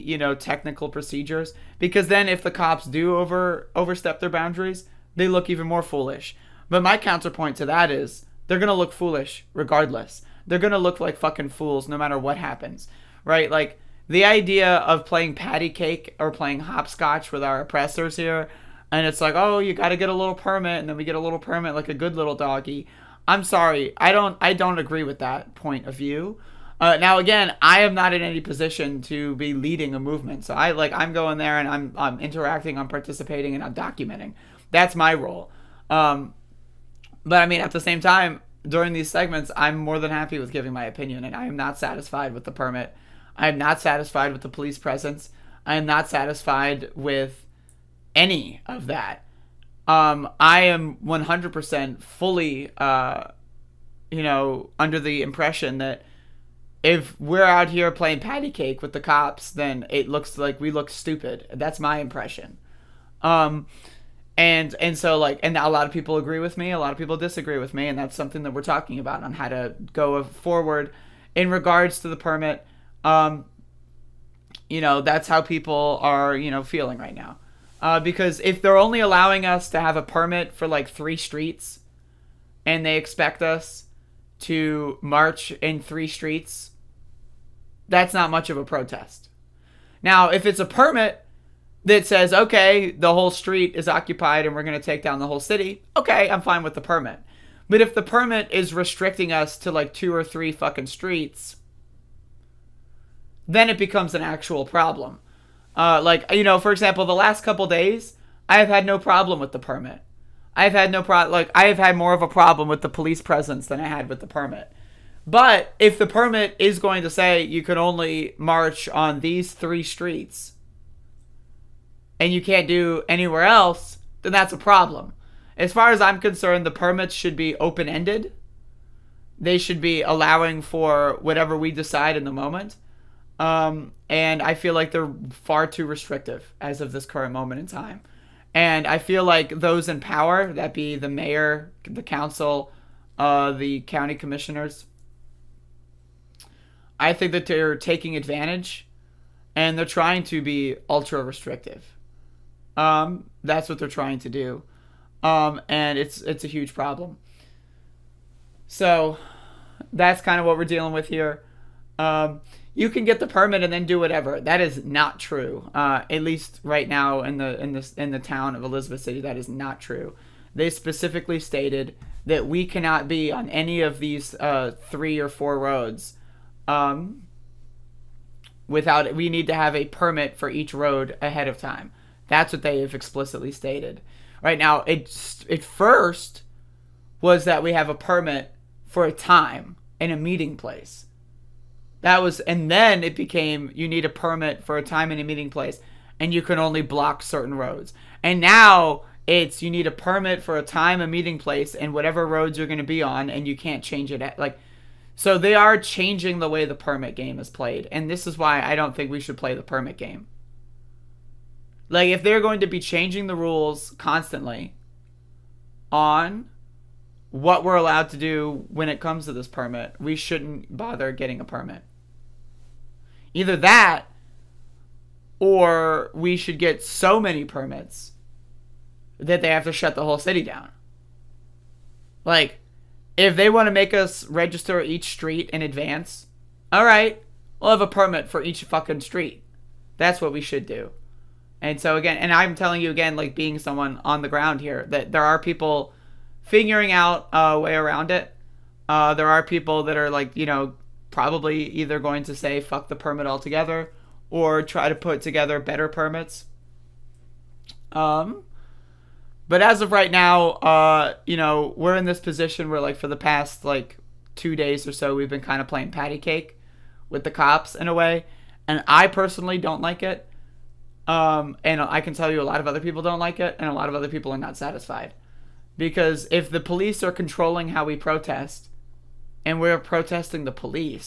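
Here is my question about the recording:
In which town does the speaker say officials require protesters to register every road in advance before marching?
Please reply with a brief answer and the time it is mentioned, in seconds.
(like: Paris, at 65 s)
Elizabeth City, at 168 s.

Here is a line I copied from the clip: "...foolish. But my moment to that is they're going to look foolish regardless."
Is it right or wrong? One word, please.
wrong.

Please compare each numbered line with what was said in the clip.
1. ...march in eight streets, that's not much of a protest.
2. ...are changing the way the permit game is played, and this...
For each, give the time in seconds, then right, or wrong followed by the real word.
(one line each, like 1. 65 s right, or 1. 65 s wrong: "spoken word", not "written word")
1. 85 s wrong: "three", not "eight"
2. 205 s right.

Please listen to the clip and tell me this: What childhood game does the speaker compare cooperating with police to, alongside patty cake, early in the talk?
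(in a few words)
hopscotch.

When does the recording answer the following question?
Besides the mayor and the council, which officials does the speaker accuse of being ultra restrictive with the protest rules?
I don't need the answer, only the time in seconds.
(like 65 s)
143 s.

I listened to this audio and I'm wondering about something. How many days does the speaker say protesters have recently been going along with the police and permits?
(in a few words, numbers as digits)
2.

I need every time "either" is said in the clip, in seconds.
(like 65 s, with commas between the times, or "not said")
223 s, 251 s.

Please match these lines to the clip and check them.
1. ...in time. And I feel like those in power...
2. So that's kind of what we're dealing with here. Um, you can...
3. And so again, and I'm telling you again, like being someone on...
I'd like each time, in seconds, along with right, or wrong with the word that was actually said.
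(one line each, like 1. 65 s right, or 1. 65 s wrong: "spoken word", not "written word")
1. 137 s right
2. 158 s right
3. 241 s right.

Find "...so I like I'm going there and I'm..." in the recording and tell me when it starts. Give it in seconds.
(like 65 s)
30 s.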